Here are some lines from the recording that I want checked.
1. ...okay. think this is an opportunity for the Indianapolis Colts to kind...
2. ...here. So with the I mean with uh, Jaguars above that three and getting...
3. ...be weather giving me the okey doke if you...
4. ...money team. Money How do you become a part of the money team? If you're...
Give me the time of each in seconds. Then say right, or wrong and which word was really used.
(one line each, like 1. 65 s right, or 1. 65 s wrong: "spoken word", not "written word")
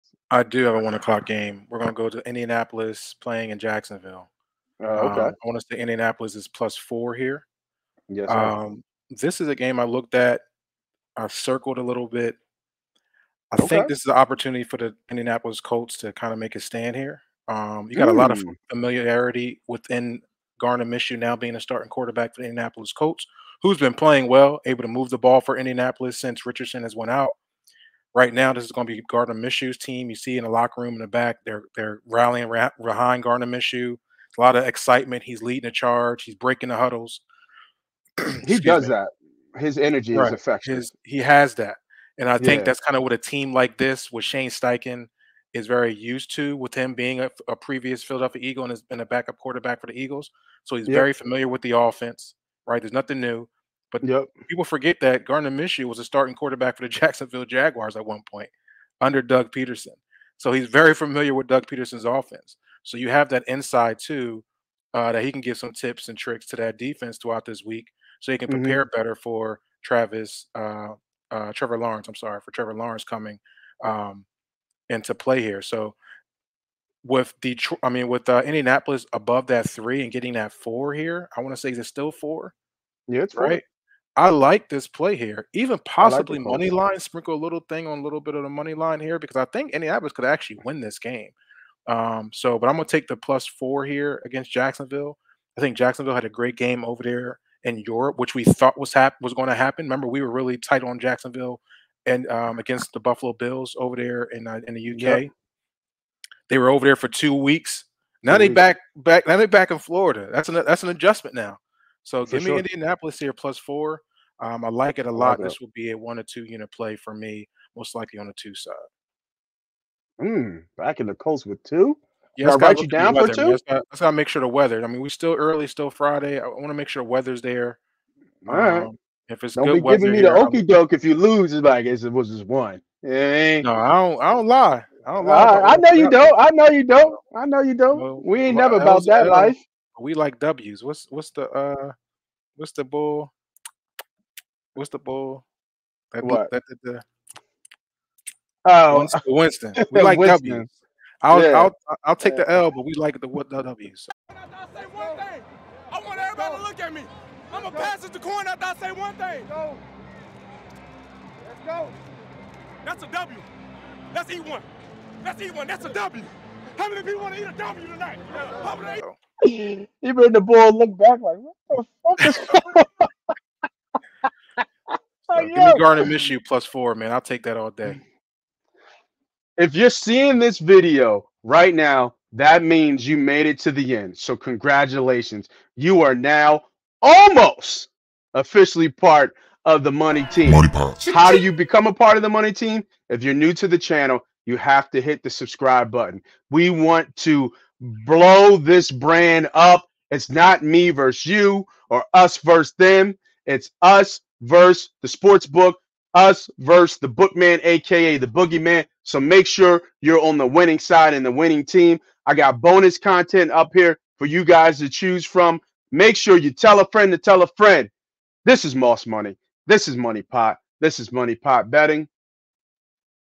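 1. 13 s right
2. 75 s wrong: "Indianapolis", not "Jaguars"
3. 129 s right
4. 189 s right.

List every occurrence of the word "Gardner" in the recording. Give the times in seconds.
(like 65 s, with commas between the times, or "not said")
20 s, 29 s, 33 s, 55 s, 175 s.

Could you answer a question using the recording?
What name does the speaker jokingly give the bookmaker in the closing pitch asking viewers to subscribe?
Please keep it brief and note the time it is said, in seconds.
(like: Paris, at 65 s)
The boogeyman, at 208 s.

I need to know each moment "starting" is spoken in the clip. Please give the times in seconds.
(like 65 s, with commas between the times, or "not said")
21 s, 56 s.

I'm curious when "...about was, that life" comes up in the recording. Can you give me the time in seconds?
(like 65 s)
138 s.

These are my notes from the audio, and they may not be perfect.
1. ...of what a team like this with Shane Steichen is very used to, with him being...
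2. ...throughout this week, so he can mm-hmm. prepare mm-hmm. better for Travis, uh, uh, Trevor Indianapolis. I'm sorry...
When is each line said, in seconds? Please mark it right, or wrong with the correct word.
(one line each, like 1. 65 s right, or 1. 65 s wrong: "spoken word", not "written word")
1. 42 s right
2. 67 s wrong: "Lawrence", not "Indianapolis".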